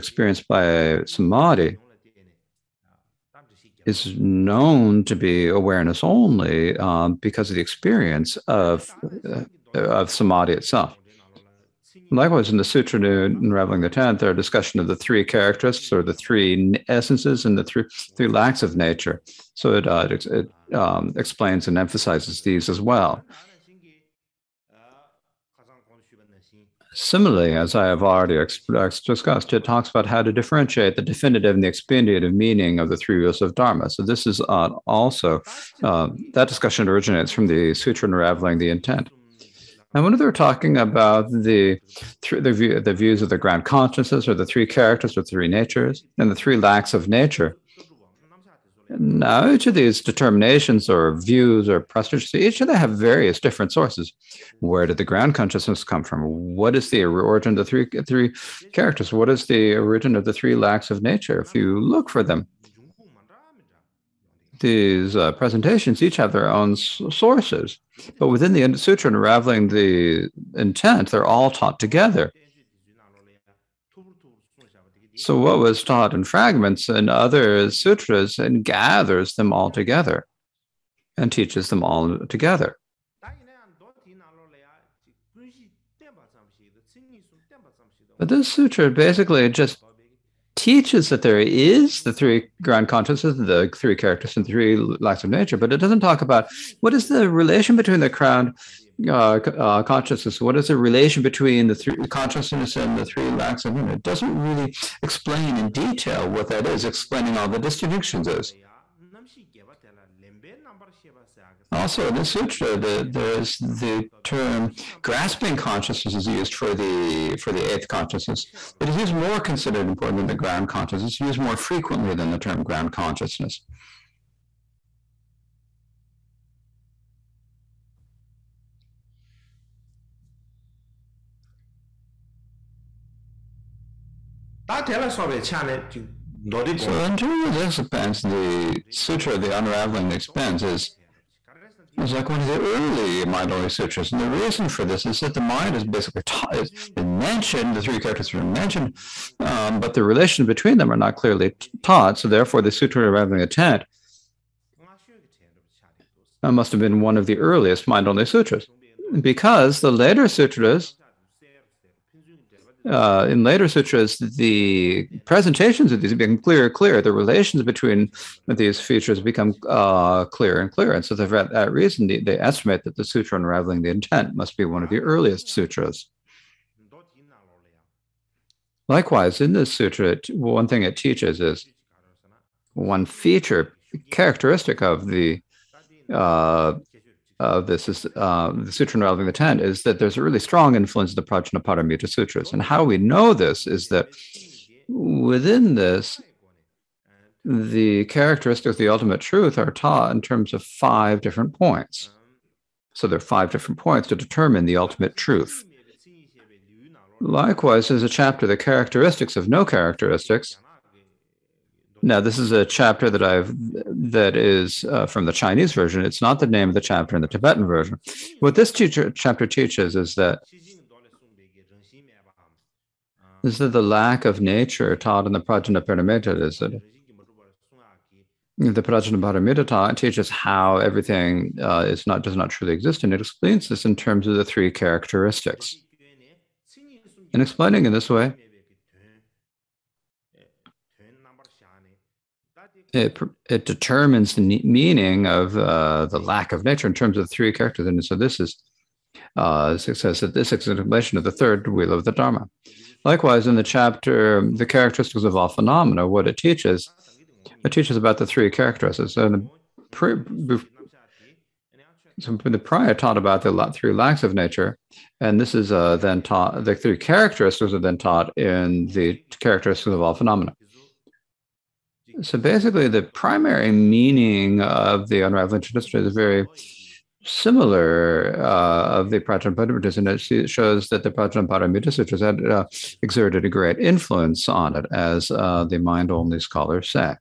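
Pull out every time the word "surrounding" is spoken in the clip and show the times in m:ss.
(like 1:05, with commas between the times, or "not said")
not said.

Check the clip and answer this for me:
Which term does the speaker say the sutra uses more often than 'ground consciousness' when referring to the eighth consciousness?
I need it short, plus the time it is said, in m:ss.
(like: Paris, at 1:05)
grasping consciousness, at 1:55.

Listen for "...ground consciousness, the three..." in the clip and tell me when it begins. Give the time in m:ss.
1:32.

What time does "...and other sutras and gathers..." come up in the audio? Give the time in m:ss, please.
1:16.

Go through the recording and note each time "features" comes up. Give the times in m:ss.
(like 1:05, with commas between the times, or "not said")
2:48, 3:03.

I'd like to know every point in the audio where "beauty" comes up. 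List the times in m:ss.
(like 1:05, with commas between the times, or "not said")
not said.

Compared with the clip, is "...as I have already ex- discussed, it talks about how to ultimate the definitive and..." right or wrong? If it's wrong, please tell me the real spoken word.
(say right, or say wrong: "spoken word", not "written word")
wrong: "differentiate", not "ultimate".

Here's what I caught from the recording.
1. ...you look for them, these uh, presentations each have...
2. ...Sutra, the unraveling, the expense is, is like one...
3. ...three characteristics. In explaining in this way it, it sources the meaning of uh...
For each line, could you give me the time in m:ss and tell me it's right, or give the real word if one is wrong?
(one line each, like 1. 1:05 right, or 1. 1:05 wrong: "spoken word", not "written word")
1. 1:01 right
2. 2:18 right
3. 3:54 wrong: "determines", not "sources".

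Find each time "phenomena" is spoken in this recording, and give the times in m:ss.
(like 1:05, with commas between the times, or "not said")
4:15, 4:30.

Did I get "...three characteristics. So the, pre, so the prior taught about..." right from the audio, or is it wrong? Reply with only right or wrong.
right.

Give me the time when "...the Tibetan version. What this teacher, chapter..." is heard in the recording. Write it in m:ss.
3:37.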